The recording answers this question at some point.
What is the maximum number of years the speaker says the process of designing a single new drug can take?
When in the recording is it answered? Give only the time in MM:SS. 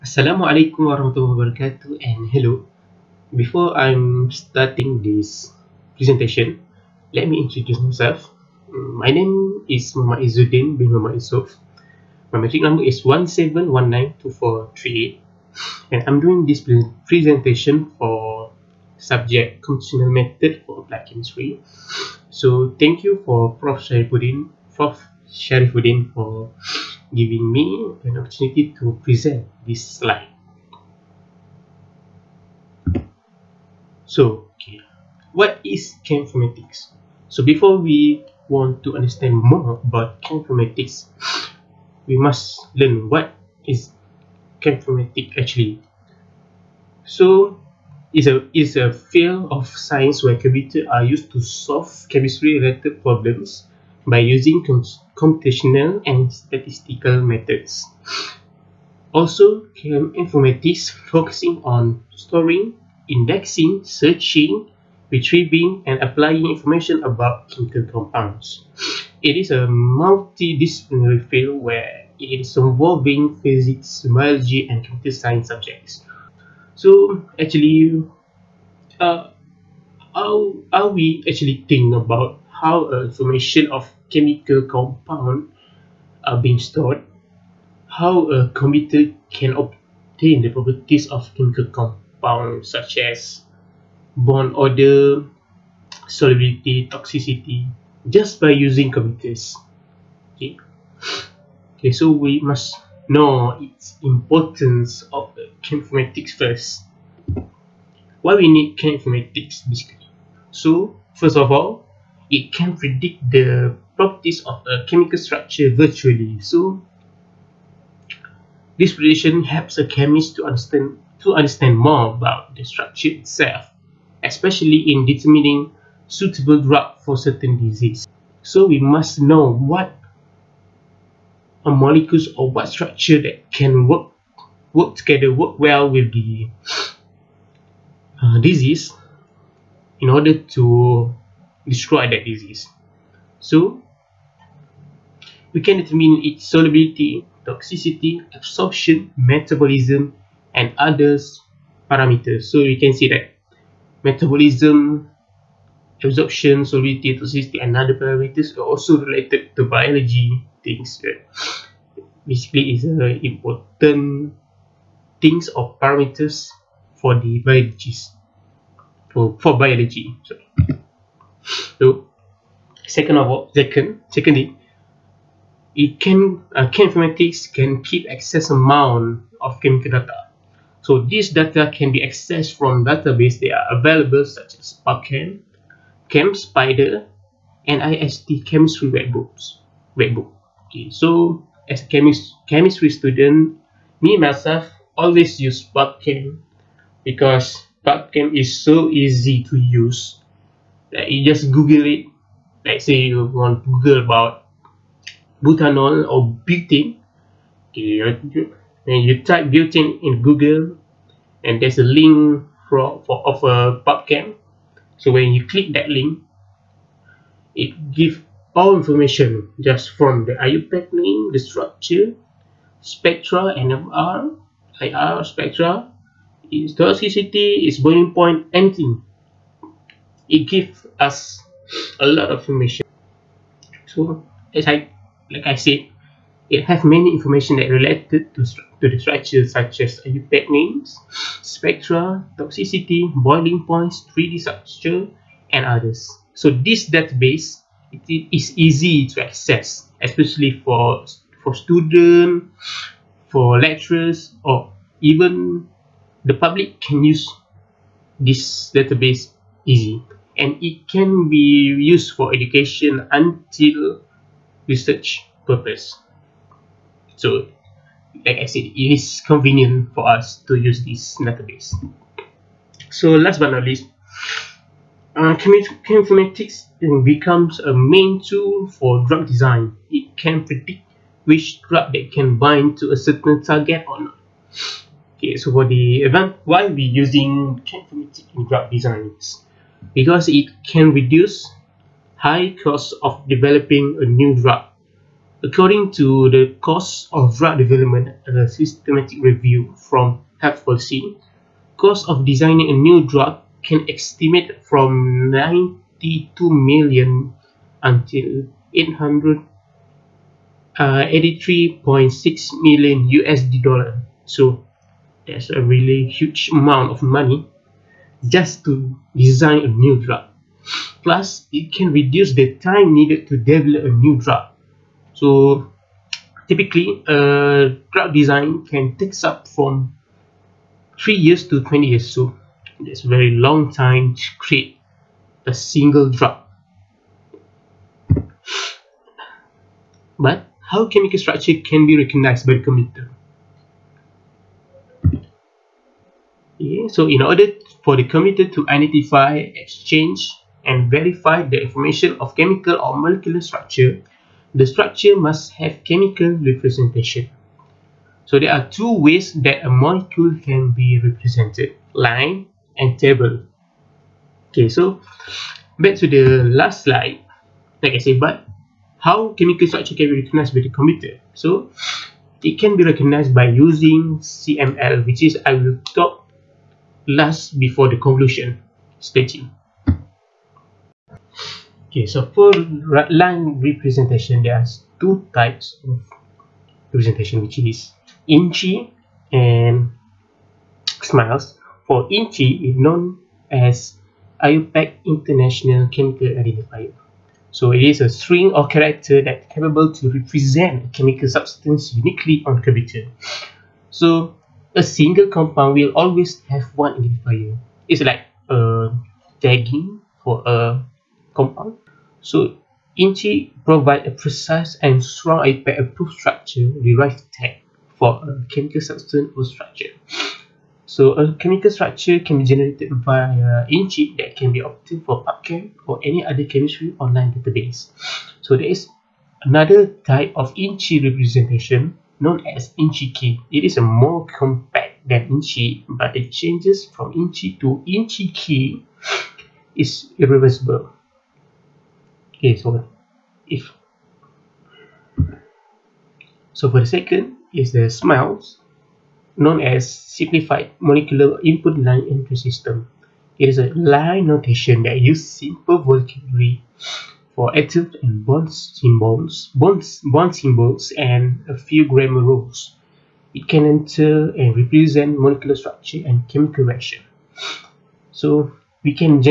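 05:31.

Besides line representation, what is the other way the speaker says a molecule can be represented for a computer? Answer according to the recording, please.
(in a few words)
Table.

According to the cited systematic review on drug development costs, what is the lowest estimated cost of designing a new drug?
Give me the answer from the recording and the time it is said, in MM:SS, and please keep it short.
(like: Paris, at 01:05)
92 million USD, at 05:05.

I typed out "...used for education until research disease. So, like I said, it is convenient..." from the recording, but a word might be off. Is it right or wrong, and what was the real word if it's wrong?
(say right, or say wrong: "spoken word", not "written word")
wrong: "purpose", not "disease".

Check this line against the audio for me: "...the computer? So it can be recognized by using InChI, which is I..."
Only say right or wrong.
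wrong.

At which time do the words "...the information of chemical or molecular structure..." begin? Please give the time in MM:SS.
05:51.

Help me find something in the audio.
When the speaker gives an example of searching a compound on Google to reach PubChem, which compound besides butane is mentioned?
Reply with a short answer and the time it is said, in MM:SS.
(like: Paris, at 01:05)
Butanol, at 03:25.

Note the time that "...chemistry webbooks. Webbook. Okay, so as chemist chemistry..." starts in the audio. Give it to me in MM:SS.
03:08.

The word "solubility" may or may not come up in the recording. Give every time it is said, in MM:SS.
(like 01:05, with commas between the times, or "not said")
01:36, 02:26, 02:36.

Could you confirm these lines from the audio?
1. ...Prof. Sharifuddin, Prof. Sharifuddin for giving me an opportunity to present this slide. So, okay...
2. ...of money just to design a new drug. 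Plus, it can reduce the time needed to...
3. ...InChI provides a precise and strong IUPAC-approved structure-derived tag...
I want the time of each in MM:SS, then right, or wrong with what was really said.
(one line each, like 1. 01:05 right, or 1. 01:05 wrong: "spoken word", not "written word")
1. 00:23 right
2. 05:16 right
3. 06:52 right.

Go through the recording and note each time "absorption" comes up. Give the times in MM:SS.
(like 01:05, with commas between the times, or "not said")
02:28, 02:36.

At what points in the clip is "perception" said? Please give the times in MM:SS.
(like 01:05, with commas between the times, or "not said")
not said.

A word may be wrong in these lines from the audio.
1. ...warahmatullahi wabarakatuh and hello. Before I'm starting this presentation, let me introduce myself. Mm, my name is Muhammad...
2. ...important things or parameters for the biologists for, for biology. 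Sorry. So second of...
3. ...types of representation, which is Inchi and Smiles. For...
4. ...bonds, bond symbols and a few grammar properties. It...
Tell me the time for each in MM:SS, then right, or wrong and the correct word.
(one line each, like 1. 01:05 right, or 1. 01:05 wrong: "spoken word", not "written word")
1. 00:00 right
2. 02:43 right
3. 06:25 right
4. 07:39 wrong: "rules", not "properties".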